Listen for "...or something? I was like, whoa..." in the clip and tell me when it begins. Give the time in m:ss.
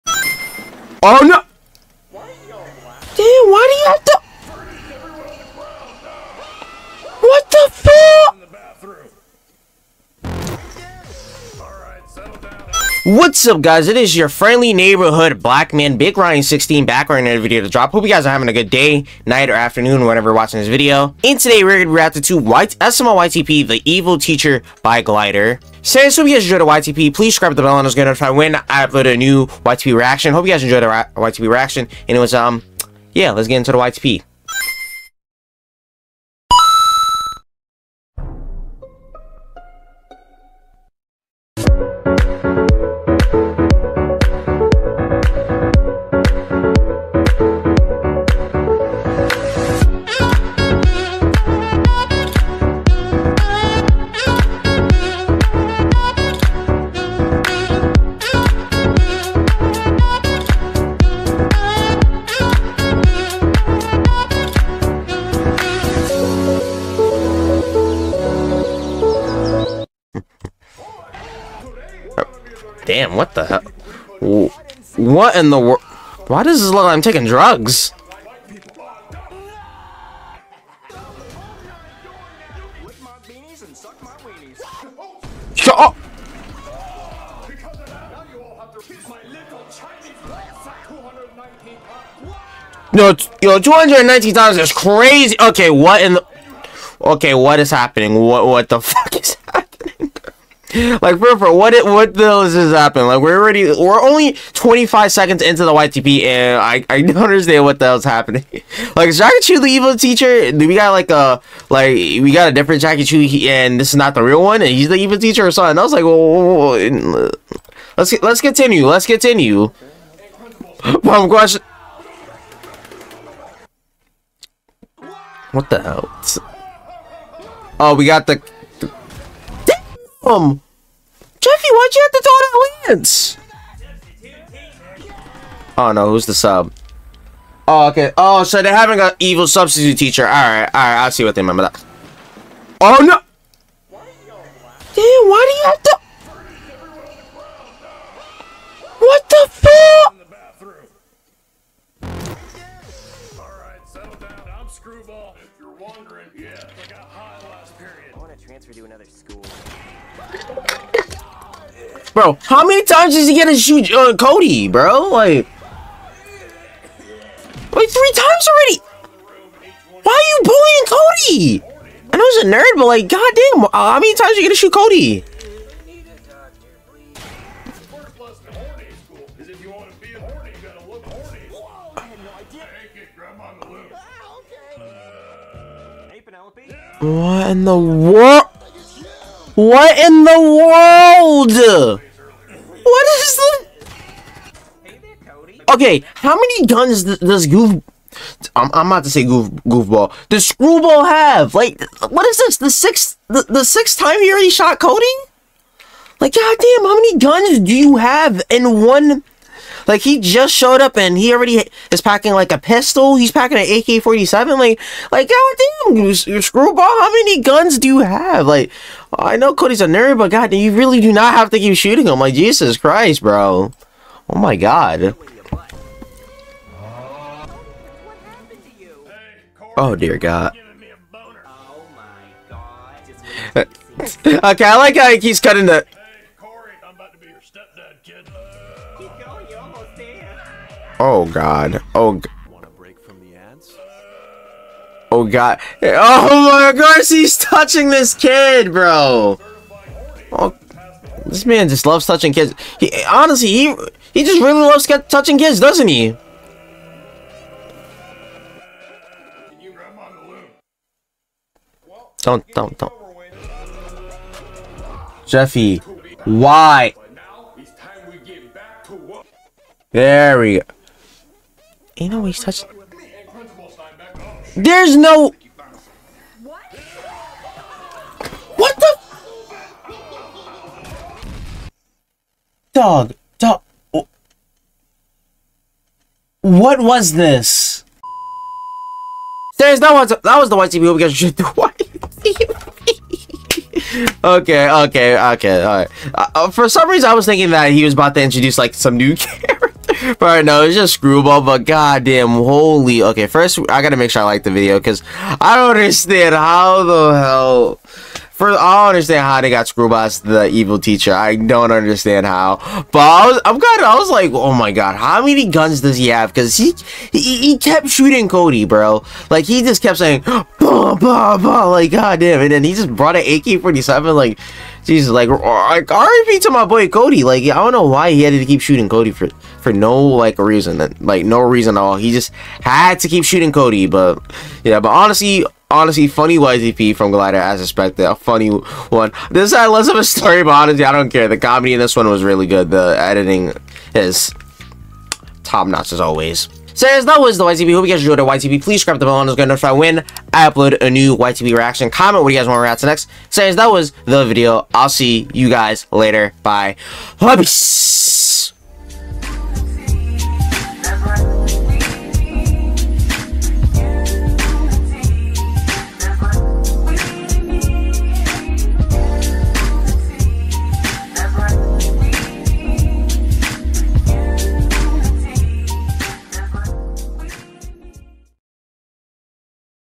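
1:55.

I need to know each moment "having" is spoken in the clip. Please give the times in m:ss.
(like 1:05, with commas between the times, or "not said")
0:18, 2:18.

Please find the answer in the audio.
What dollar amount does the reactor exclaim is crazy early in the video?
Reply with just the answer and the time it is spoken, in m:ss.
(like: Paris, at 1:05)
219 dollars, at 1:33.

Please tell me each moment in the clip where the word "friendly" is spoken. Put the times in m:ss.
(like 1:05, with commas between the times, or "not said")
0:14.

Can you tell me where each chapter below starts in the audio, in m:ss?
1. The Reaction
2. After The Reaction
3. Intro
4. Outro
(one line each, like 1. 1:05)
1. 1:10
2. 4:47
3. 0:34
4. 5:58.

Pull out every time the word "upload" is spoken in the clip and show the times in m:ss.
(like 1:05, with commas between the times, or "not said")
0:28, 5:50.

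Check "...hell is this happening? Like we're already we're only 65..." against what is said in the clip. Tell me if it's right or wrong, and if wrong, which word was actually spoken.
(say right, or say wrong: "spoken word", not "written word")
wrong: "25", not "65".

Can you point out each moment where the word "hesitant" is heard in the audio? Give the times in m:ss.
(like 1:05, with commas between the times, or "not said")
not said.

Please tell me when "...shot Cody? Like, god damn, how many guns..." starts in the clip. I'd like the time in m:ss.
3:24.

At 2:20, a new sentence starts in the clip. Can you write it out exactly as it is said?
Alright, alright, I see what they meant by that.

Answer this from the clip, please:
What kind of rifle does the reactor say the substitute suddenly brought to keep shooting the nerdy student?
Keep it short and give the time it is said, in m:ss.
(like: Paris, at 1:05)
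AK-47, at 3:33.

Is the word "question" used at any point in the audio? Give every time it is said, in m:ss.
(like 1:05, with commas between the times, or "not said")
2:01.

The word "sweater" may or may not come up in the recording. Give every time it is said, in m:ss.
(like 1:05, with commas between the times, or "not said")
not said.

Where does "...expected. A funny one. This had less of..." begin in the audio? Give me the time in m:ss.
5:37.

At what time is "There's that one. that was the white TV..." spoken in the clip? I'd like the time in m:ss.
4:49.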